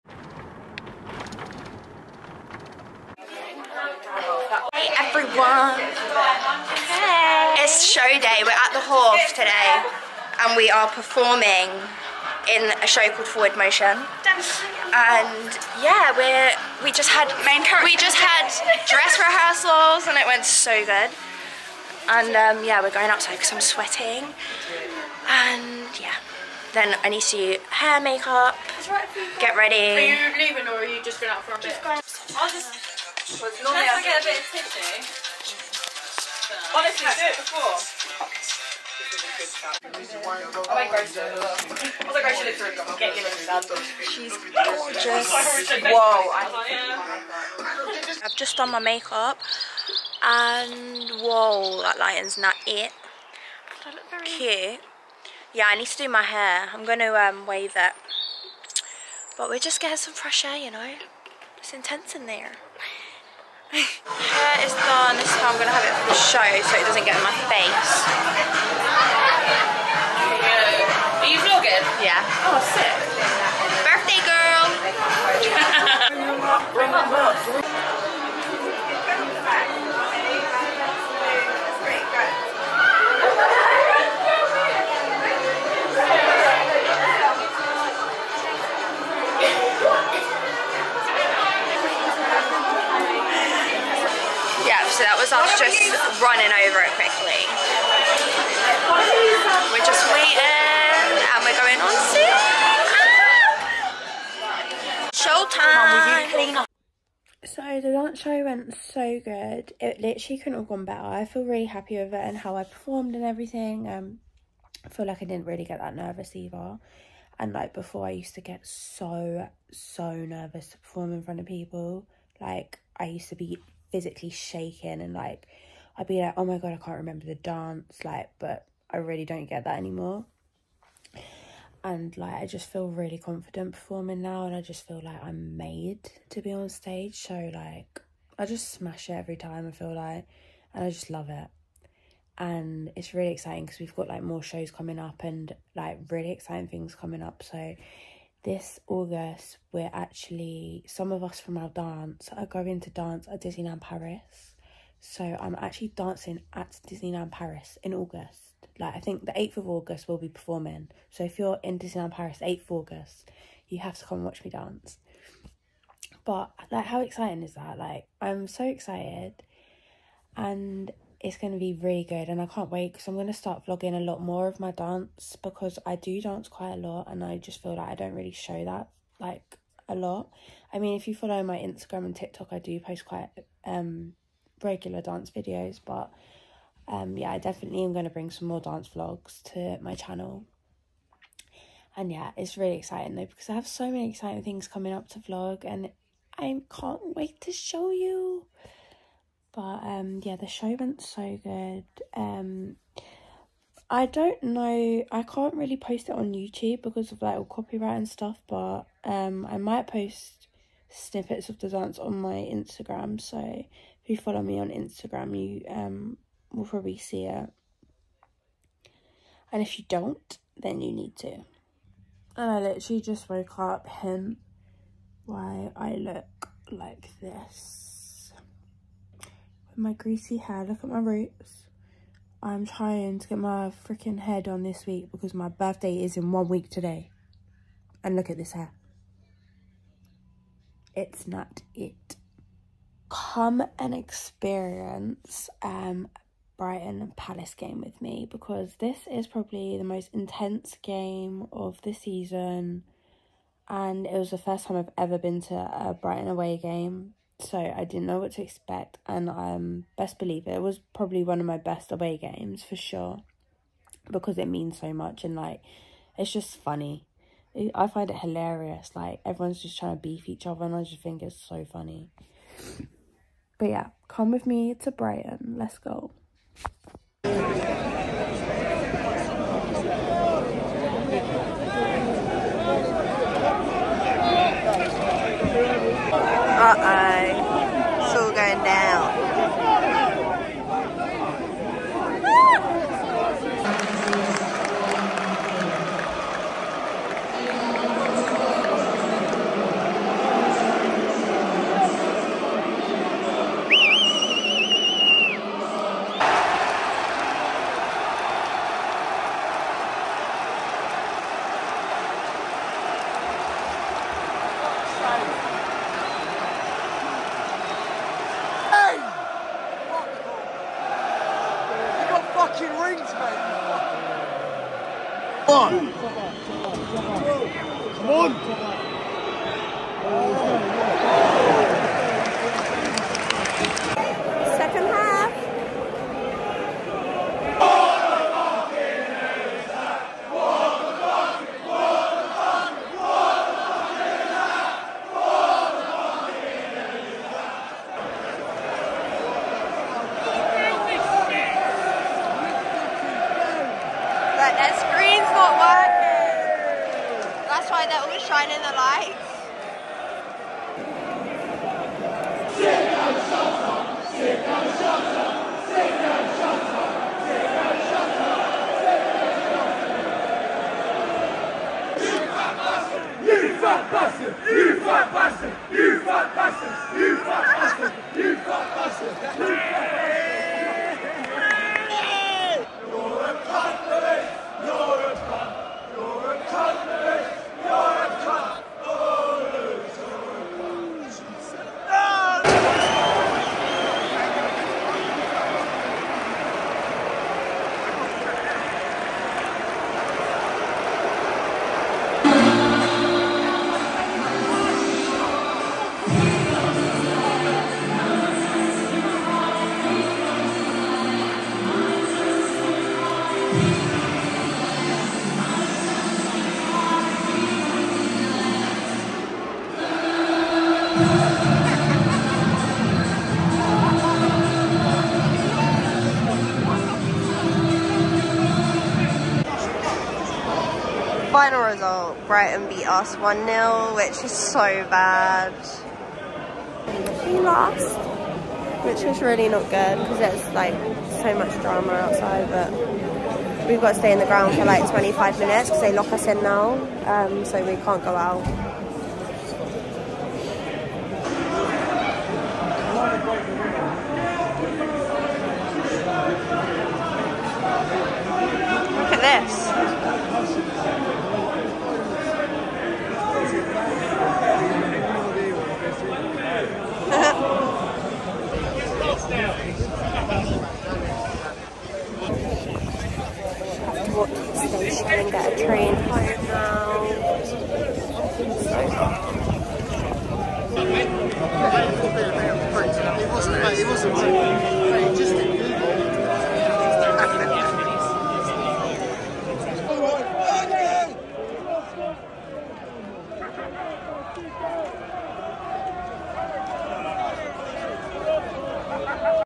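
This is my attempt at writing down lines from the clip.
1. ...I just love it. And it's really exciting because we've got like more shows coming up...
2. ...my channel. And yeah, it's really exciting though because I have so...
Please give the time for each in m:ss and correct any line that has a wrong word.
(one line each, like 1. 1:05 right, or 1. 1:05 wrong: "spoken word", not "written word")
1. 2:20 right
2. 3:09 right.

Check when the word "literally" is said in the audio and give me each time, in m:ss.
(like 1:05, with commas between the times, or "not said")
1:50, 3:42.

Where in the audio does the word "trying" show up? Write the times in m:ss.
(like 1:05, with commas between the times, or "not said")
3:52, 4:29.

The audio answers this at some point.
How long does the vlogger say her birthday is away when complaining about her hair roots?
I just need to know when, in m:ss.
3:56.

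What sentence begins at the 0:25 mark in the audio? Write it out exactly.
And yeah, then I need to do hair, makeup, get ready.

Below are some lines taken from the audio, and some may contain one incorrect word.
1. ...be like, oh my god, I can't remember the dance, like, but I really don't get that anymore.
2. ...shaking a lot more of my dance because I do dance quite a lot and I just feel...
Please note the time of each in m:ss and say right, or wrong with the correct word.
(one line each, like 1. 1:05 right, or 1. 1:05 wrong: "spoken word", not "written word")
1. 2:06 right
2. 2:53 wrong: "vlogging", not "shaking".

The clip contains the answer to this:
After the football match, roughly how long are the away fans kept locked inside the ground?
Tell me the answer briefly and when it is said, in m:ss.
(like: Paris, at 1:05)
25 minutes, at 7:24.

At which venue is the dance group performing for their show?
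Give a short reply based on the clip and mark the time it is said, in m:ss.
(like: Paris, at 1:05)
the Hove, at 0:08.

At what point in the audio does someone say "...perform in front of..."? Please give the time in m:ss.
2:00.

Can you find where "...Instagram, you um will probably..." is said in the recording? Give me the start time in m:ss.
3:34.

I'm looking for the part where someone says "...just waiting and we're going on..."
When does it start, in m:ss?
1:39.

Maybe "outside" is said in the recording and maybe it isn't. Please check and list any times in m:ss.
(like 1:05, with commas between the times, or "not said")
0:23, 7:21.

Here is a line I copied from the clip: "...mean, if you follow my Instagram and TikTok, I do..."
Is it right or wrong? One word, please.
right.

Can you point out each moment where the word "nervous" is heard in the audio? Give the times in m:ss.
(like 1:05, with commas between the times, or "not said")
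1:55, 2:00.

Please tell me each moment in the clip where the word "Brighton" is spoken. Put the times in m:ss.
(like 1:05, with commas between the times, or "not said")
4:06, 4:15, 4:34, 7:12.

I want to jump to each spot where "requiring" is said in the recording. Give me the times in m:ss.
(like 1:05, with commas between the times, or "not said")
not said.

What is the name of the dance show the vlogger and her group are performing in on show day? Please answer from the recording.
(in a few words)
Forward Motion.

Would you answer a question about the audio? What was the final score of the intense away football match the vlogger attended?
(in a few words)
1-0.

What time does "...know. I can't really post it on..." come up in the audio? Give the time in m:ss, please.
3:24.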